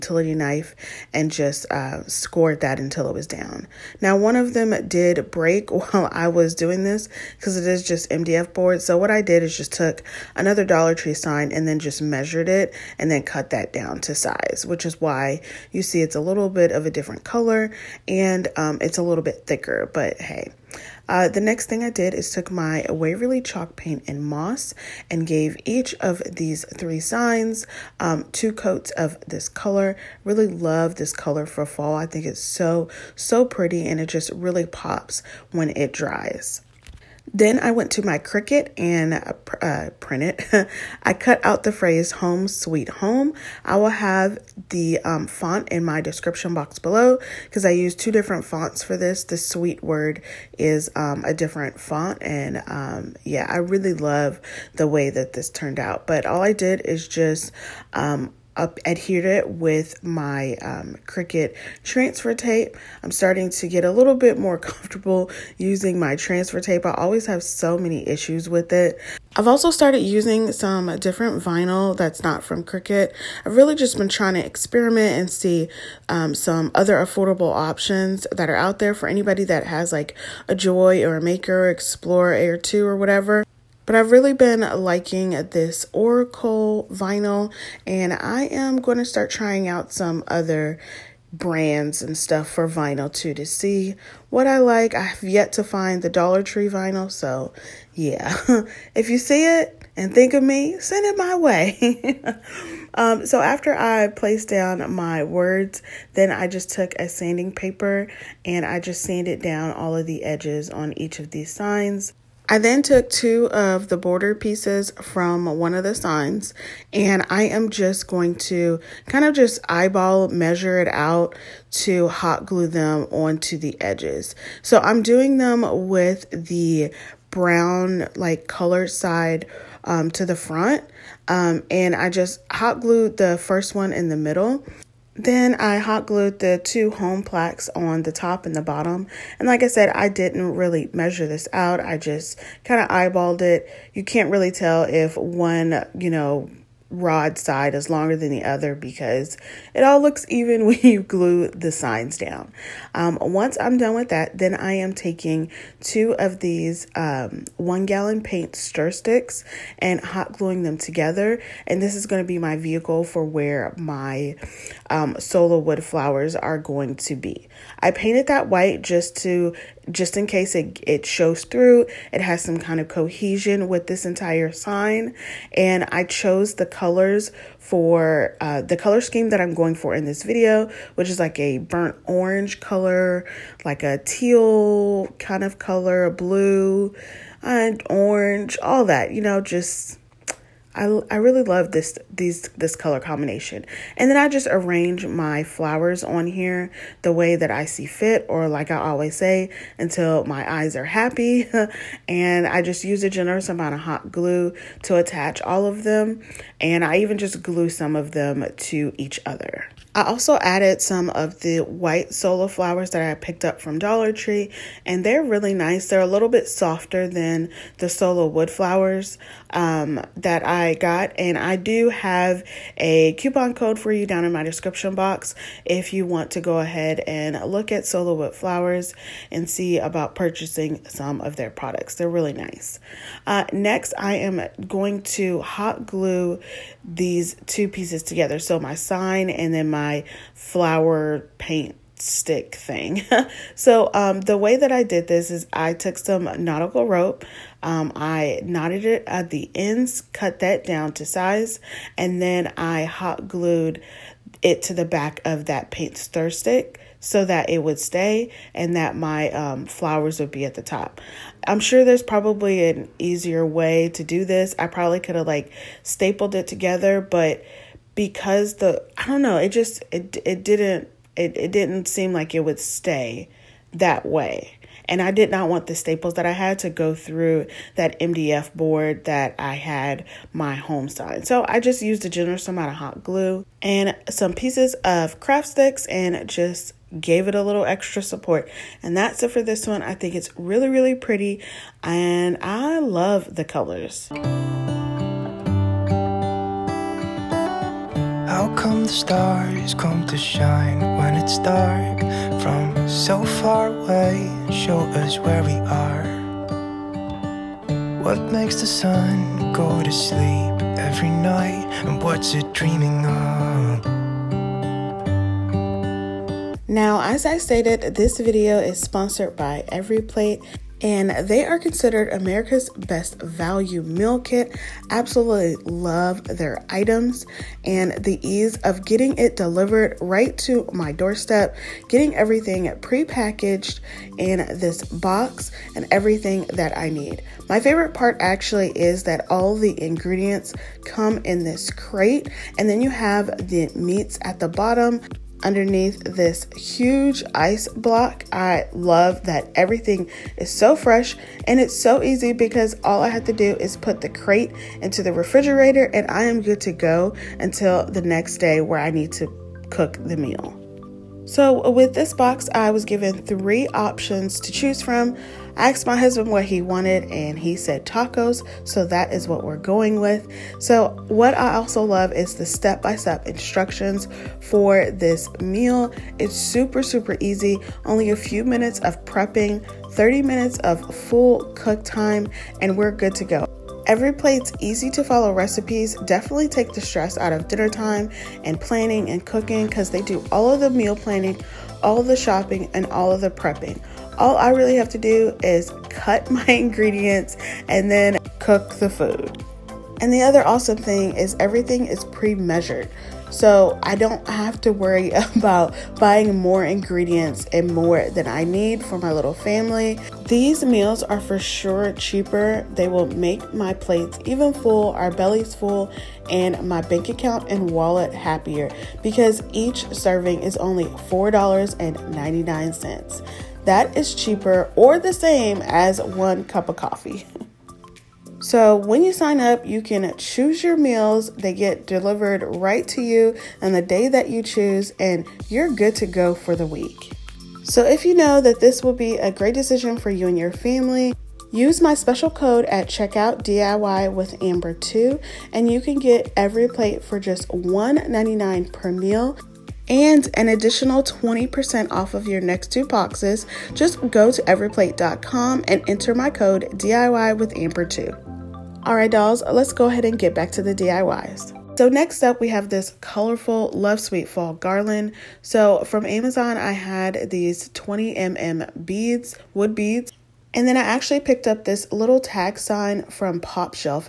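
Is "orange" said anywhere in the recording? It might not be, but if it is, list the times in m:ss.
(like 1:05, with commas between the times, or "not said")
3:02, 3:07.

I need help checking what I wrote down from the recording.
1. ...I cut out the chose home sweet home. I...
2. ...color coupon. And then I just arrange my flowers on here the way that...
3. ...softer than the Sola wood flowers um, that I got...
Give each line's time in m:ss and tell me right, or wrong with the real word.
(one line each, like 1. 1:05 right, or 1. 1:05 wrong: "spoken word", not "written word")
1. 0:41 wrong: "phrase", not "chose"
2. 3:12 wrong: "combination", not "coupon"
3. 3:36 right.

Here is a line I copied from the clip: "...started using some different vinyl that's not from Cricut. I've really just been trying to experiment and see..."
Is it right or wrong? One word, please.
right.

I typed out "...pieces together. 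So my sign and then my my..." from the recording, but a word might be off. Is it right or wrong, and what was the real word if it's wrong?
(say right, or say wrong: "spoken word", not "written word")
right.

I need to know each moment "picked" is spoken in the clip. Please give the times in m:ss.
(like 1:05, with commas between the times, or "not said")
3:33, 7:51.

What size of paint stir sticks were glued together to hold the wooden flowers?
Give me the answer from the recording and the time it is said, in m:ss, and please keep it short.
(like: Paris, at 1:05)
one gallon, at 2:37.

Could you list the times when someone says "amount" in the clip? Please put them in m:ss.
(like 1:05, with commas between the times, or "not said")
3:23, 4:42.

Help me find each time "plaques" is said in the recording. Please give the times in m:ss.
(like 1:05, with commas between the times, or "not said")
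2:17.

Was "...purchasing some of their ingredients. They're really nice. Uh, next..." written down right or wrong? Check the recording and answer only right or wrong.
wrong.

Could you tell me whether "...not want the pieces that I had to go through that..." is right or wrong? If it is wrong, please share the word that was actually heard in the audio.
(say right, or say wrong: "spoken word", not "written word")
wrong: "staples", not "pieces".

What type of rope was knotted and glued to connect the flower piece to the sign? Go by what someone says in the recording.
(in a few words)
nautical rope.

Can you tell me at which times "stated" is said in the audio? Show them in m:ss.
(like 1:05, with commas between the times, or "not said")
5:17.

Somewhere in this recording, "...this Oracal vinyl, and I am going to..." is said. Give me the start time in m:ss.
1:25.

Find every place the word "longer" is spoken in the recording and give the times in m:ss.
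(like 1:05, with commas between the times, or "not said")
2:27.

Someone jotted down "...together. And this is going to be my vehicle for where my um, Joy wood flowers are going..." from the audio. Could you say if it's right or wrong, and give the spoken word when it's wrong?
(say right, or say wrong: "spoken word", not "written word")
wrong: "Sola", not "Joy".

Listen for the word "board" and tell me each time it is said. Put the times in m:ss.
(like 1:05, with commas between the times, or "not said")
0:08, 4:38.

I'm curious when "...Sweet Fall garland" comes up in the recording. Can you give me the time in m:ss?
7:43.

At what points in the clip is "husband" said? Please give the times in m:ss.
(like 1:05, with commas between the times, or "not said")
6:05.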